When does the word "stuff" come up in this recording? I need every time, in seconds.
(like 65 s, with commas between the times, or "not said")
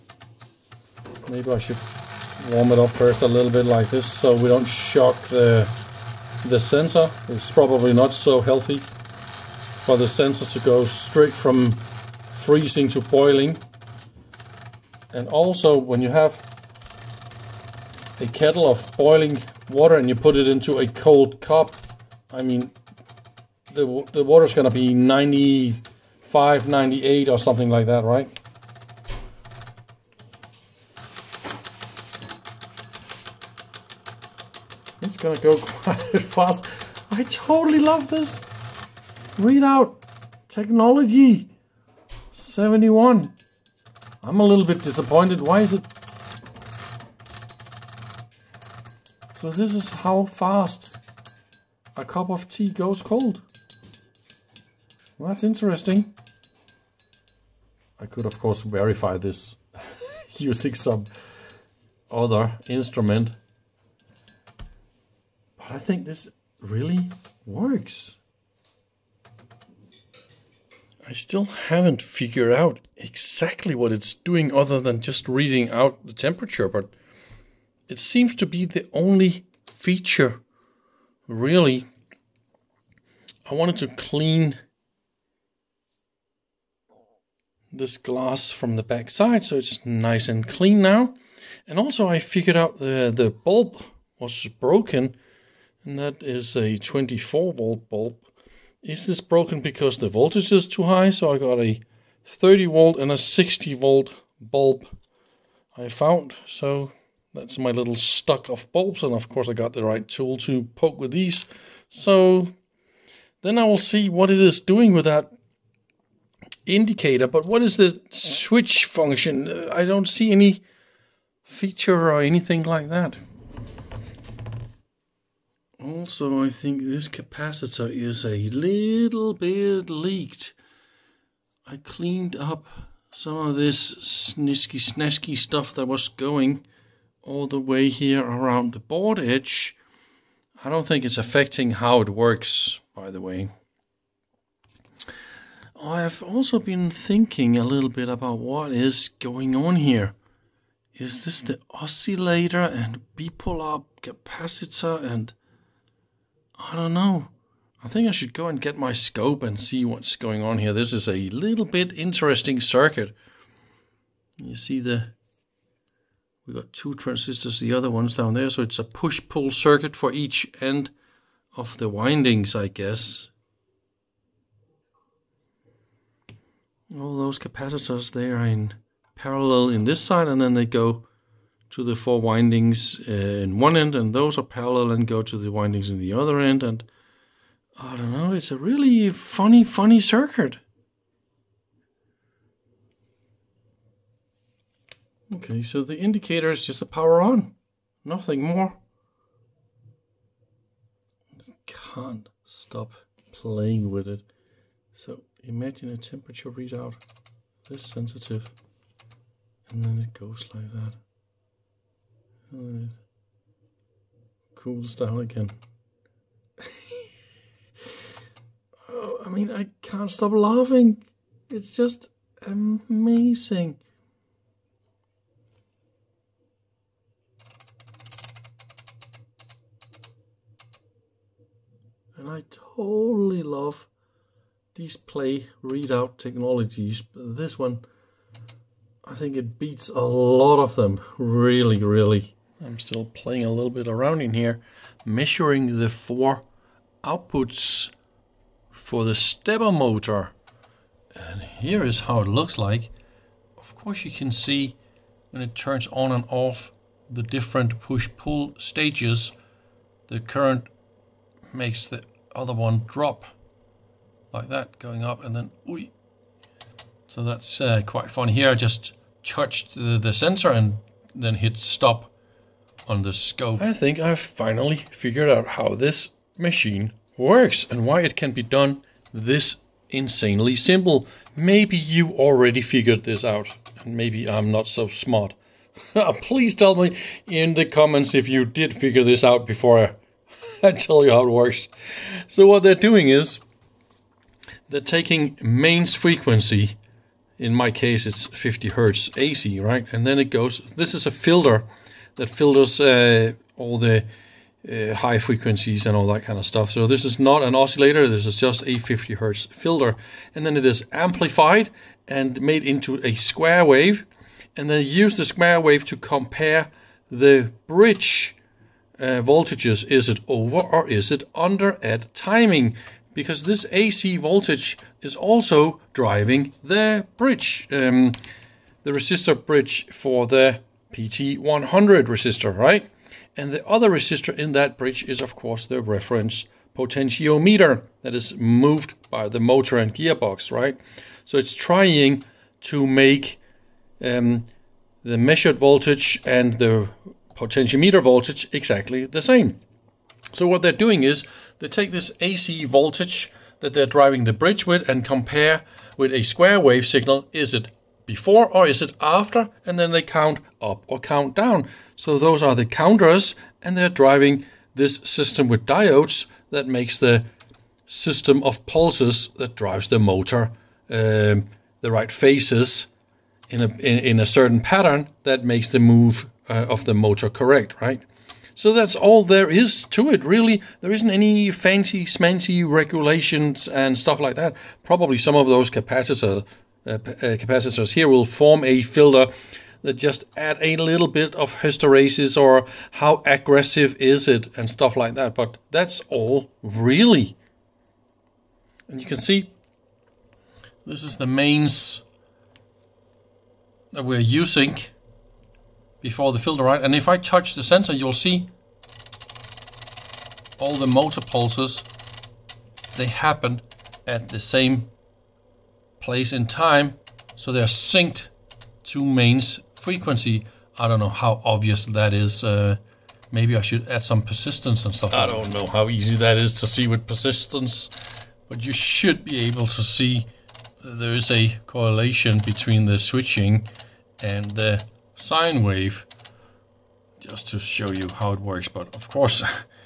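135 s, 306 s, 383 s, 394 s, 424 s.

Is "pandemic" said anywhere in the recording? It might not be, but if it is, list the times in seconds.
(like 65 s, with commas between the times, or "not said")
not said.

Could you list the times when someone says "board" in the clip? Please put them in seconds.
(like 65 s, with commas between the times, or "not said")
138 s.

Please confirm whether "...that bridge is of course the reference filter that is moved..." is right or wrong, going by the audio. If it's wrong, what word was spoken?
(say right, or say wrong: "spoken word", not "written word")
wrong: "potentiometer", not "filter".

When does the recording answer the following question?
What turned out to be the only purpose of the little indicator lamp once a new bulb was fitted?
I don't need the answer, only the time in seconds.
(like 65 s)
196 s.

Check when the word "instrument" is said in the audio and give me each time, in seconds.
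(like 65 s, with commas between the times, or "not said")
62 s.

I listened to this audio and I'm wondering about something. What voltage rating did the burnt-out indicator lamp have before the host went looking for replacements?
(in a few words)
24 volts.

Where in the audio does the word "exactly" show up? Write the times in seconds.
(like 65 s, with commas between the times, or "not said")
72 s, 348 s.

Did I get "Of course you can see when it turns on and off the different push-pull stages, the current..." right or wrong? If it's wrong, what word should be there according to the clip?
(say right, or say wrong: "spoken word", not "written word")
right.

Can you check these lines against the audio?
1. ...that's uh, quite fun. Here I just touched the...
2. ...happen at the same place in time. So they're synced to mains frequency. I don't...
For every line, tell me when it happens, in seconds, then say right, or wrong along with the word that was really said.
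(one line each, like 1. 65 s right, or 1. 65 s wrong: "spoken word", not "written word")
1. 267 s right
2. 413 s right.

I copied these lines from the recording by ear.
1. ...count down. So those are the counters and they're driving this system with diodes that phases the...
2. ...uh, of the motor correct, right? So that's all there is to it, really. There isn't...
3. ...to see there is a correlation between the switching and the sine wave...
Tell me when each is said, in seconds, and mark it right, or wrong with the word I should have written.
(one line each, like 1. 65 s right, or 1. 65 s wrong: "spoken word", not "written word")
1. 360 s wrong: "makes", not "phases"
2. 376 s right
3. 429 s right.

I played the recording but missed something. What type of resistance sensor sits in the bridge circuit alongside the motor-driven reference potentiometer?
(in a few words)
PT100.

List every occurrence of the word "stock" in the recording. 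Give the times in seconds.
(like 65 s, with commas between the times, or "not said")
107 s.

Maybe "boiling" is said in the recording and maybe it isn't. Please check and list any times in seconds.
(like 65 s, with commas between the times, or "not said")
13 s, 18 s.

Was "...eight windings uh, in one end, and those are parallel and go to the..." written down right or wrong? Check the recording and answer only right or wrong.
wrong.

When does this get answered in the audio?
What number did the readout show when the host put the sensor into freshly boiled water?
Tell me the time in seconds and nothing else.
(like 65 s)
42 s.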